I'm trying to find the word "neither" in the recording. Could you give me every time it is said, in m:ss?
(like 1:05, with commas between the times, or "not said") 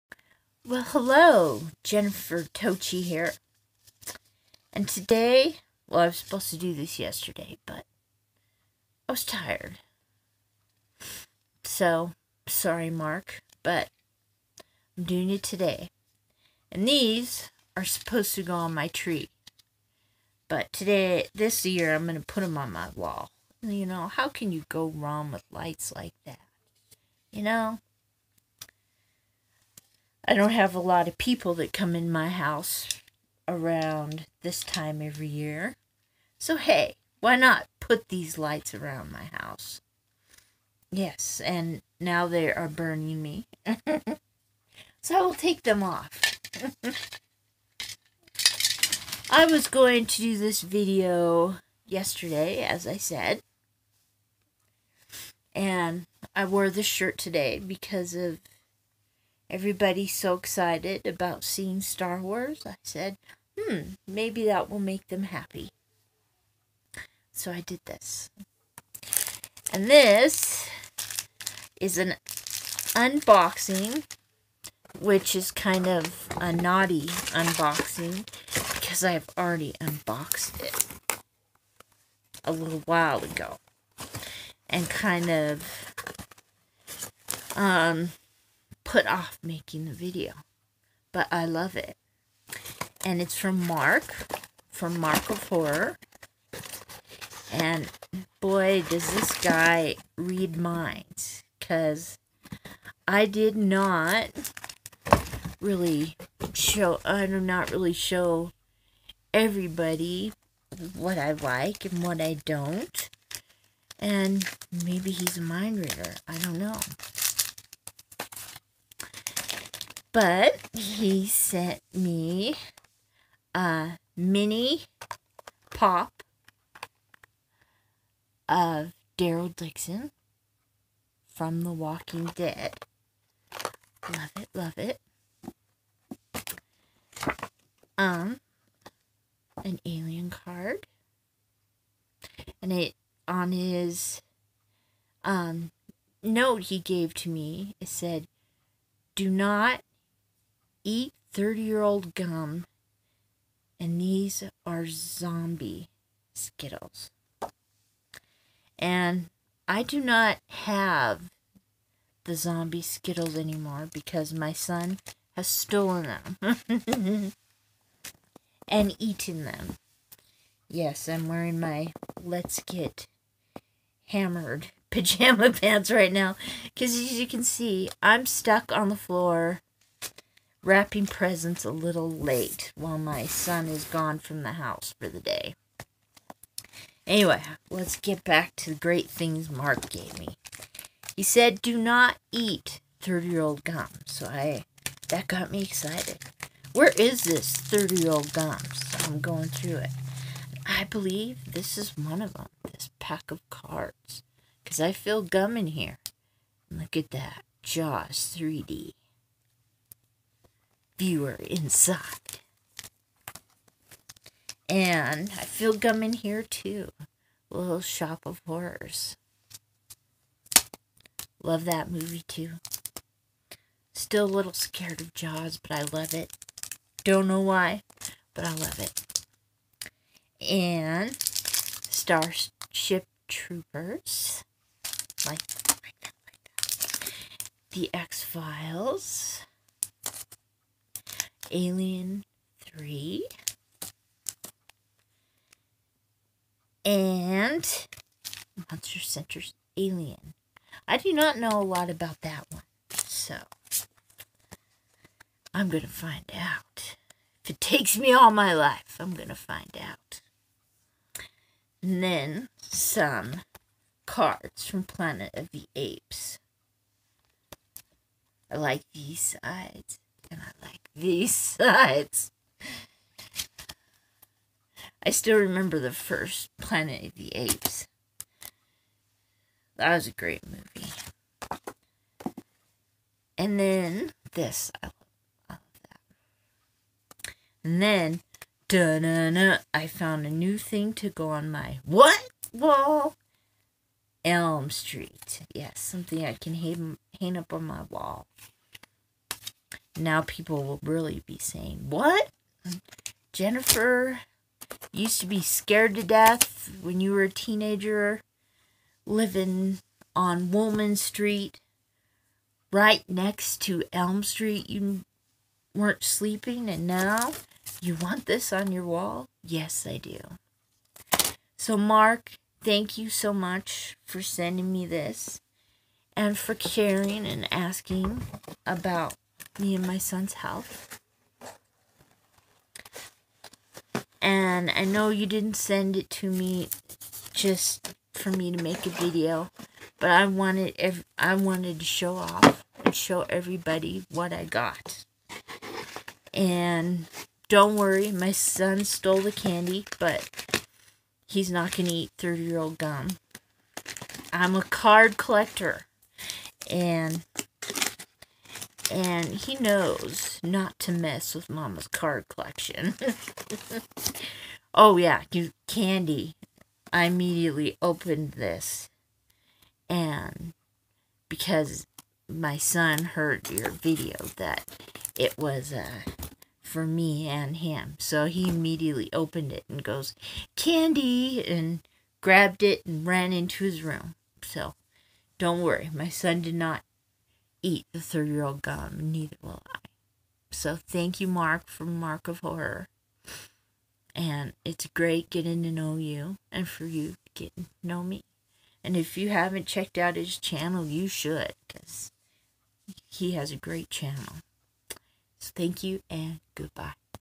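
6:29.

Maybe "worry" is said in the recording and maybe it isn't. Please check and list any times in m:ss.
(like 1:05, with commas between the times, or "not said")
5:47, 6:25.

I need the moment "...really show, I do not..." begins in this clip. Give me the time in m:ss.
1:45.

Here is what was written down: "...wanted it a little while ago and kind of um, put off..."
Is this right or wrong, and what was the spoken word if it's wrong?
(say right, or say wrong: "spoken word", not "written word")
wrong: "unboxed", not "wanted".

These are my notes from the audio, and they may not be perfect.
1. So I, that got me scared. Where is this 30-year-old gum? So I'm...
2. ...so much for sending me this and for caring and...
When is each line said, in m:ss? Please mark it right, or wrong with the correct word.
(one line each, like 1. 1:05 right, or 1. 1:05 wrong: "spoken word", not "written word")
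1. 3:14 wrong: "excited", not "scared"
2. 5:23 right.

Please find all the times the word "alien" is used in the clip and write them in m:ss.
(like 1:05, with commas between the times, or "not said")
2:19, 4:01, 4:09.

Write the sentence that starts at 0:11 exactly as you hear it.
So, sorry, Marc, but I'm doing it today.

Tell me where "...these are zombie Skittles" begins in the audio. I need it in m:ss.
2:33.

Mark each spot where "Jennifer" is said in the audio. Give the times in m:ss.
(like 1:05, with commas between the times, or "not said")
0:01, 5:03.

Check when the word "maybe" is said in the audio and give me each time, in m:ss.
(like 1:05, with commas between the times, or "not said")
1:04, 1:54.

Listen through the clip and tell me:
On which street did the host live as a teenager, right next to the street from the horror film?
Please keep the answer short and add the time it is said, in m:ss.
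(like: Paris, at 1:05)
Woolman Street, at 5:10.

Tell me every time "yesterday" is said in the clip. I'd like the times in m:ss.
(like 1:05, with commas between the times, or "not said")
0:06, 0:51.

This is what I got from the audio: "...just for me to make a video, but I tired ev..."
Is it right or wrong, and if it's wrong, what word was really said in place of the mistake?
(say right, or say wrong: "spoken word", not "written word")
wrong: "wanted", not "tired".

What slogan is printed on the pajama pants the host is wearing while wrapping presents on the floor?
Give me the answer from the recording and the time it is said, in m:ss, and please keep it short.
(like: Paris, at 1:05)
Let's Get Hammered, at 2:52.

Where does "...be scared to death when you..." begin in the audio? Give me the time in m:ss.
5:05.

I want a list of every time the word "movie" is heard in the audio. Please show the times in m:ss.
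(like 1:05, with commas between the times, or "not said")
3:41, 4:40.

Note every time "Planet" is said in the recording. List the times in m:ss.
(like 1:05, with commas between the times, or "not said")
4:24, 4:36.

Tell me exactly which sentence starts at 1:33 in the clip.
And it's from Marc, from Marc of Horror.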